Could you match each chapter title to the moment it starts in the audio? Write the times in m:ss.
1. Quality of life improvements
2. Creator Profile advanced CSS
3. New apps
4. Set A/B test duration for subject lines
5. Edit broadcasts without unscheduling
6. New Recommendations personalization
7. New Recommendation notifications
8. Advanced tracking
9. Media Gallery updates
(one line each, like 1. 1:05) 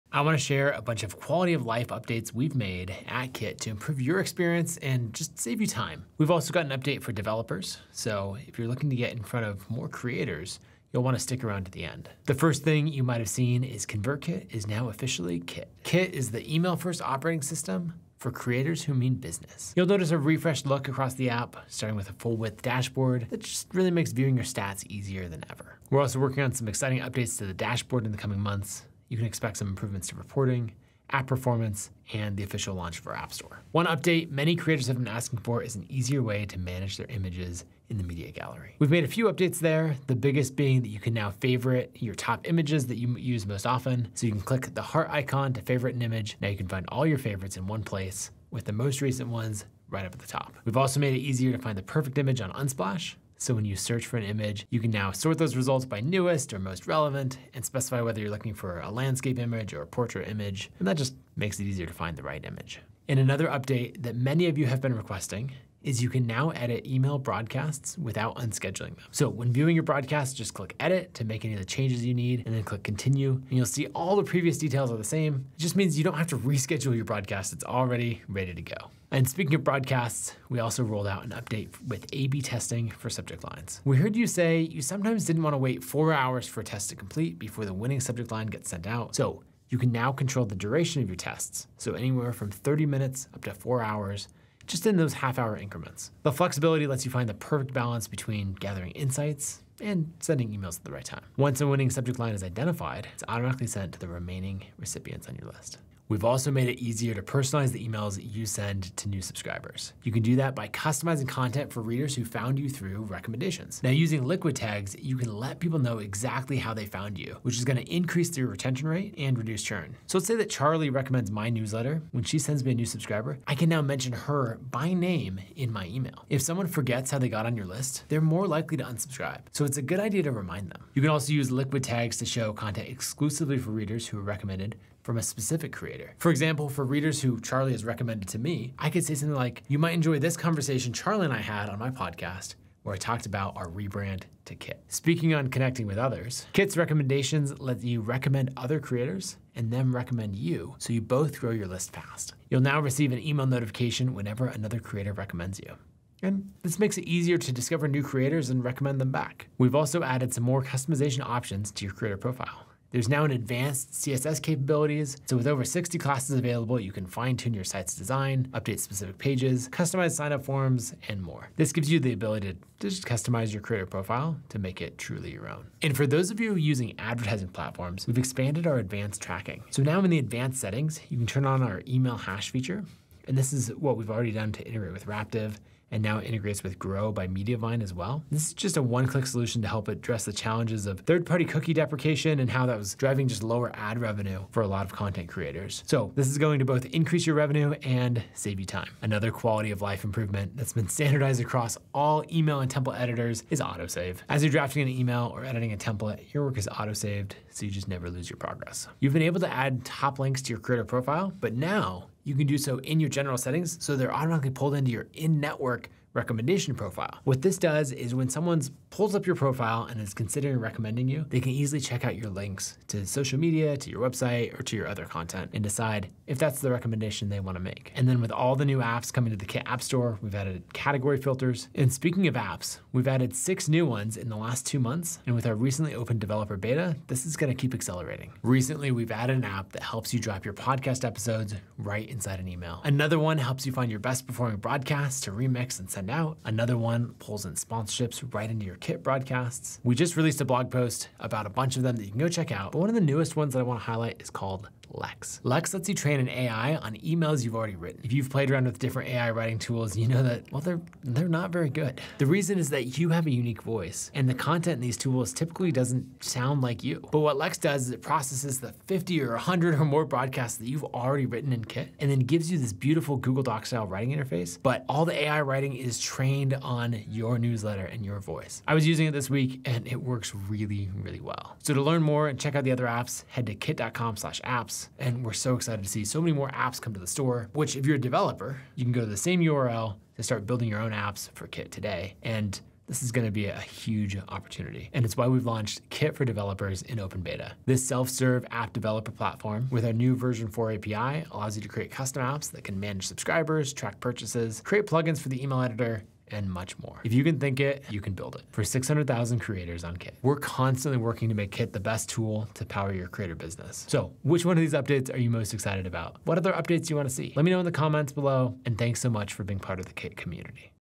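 1. 3:19
2. 2:40
3. 3:53
4. 1:19
5. 1:04
6. 1:46
7. 2:25
8. 2:56
9. 0:33.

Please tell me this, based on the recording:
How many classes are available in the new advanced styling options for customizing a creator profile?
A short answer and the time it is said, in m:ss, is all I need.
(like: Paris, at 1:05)
60, at 2:45.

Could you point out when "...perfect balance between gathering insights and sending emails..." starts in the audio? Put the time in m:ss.
1:37.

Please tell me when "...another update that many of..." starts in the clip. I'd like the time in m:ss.
1:03.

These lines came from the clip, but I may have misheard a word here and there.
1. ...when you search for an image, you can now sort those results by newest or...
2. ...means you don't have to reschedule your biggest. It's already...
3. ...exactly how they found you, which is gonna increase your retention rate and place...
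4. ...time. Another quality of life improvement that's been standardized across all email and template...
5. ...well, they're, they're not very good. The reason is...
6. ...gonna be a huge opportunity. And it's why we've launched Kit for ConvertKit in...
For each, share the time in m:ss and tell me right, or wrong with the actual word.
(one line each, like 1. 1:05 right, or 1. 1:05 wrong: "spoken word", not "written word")
1. 0:53 right
2. 1:15 wrong: "broadcast", not "biggest"
3. 1:55 wrong: "reduce", not "place"
4. 3:18 right
5. 4:20 right
6. 4:53 wrong: "Developers", not "ConvertKit".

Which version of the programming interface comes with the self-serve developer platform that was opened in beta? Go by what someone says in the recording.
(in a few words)
Version 4.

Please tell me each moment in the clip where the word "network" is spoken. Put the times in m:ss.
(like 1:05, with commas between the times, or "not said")
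3:35.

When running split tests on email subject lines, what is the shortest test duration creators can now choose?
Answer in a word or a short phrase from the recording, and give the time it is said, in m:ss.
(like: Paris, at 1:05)
30 minutes, at 1:32.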